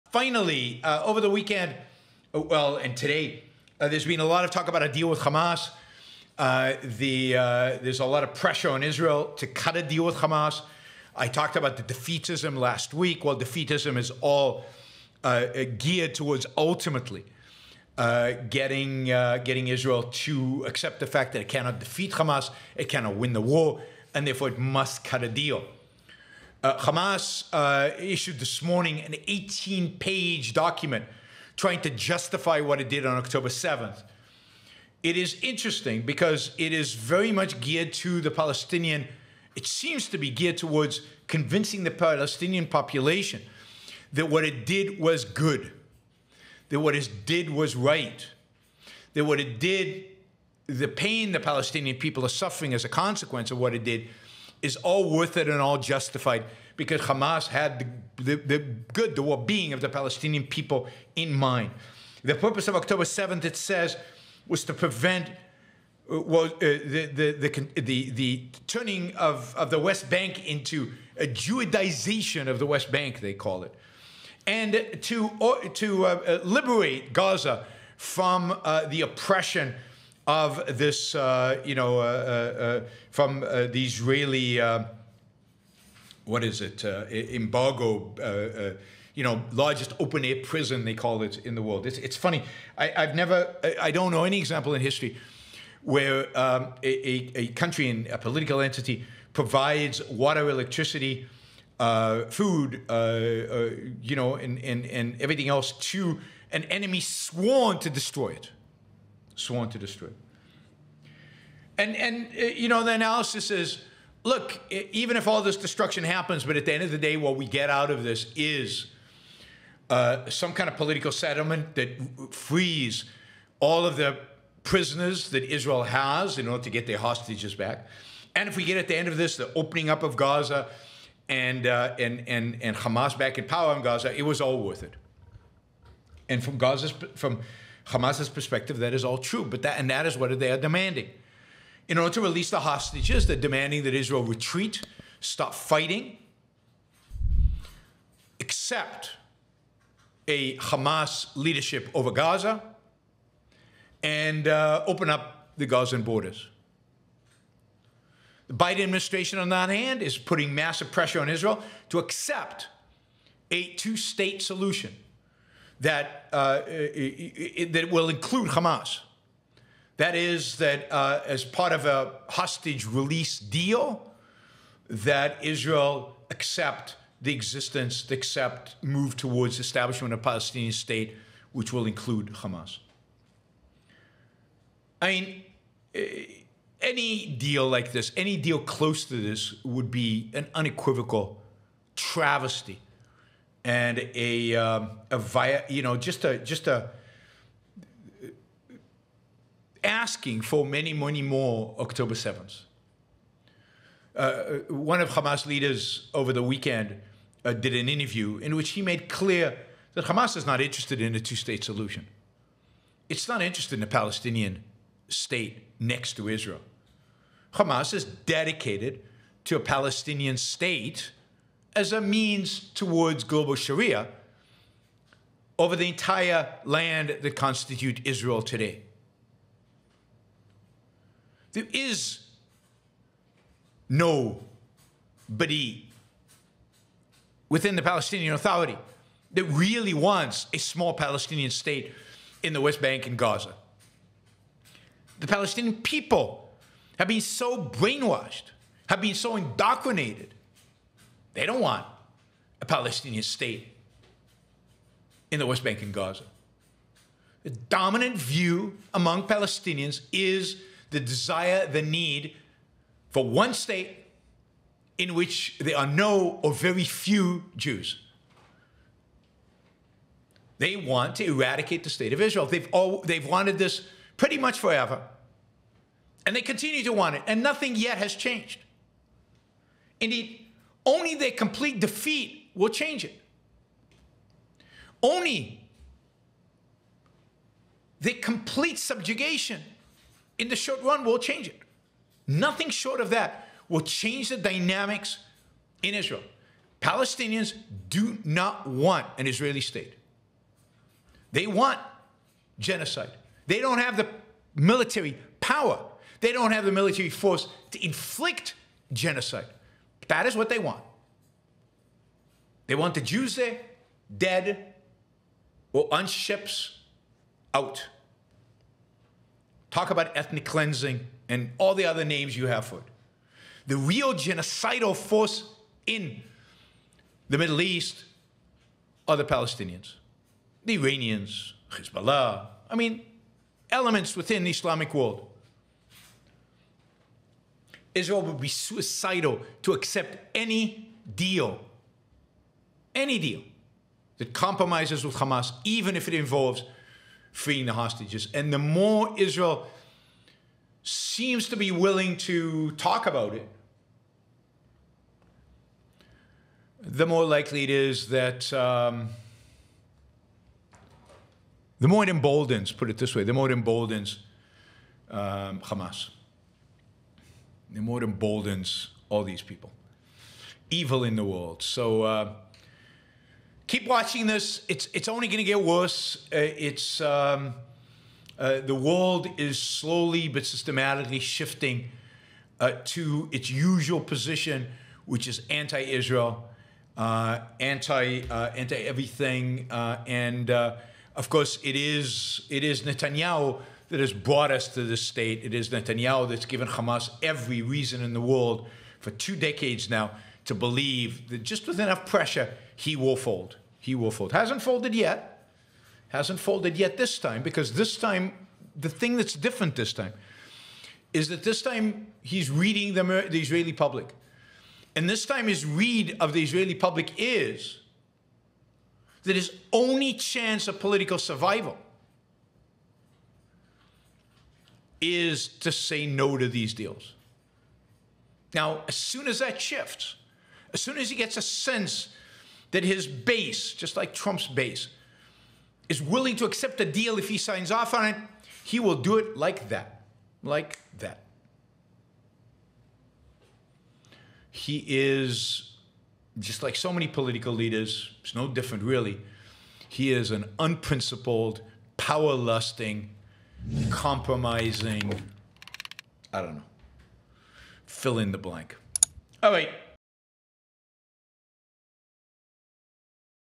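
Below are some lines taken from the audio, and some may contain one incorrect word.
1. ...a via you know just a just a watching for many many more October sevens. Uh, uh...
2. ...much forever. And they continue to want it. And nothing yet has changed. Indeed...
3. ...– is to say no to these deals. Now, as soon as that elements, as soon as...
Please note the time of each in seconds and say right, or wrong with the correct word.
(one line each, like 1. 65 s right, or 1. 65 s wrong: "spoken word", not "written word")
1. 195 s wrong: "asking", not "watching"
2. 274 s right
3. 421 s wrong: "shifts", not "elements".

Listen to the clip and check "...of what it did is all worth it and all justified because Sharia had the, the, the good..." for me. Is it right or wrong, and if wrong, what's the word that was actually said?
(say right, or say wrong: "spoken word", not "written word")
wrong: "Hamas", not "Sharia".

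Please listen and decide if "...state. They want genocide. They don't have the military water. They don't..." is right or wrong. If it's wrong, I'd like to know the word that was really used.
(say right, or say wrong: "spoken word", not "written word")
wrong: "power", not "water".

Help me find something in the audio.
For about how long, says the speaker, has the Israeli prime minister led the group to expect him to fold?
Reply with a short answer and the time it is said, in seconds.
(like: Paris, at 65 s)
two decades, at 399 s.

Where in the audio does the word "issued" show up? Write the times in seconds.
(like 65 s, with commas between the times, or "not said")
27 s.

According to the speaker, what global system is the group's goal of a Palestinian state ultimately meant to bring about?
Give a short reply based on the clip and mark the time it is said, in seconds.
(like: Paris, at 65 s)
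global Sharia, at 223 s.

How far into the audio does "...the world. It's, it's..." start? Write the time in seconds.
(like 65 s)
91 s.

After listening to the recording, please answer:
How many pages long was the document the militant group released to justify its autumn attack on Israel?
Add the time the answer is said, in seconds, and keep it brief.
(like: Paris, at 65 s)
18, at 29 s.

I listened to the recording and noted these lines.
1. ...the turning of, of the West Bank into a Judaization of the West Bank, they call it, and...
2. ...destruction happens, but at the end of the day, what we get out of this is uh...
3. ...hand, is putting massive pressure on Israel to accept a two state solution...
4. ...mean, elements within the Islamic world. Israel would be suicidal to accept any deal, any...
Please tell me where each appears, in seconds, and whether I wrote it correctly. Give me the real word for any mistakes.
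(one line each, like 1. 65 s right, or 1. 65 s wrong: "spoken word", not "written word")
1. 68 s right
2. 115 s right
3. 159 s right
4. 332 s right.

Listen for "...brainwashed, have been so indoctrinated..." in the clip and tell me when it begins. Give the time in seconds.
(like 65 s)
247 s.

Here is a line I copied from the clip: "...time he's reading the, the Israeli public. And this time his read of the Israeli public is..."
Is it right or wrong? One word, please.
right.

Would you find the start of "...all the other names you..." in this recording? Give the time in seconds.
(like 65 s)
321 s.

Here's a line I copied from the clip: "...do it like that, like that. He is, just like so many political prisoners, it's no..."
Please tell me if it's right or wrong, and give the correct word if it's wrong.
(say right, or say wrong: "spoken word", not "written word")
wrong: "leaders", not "prisoners".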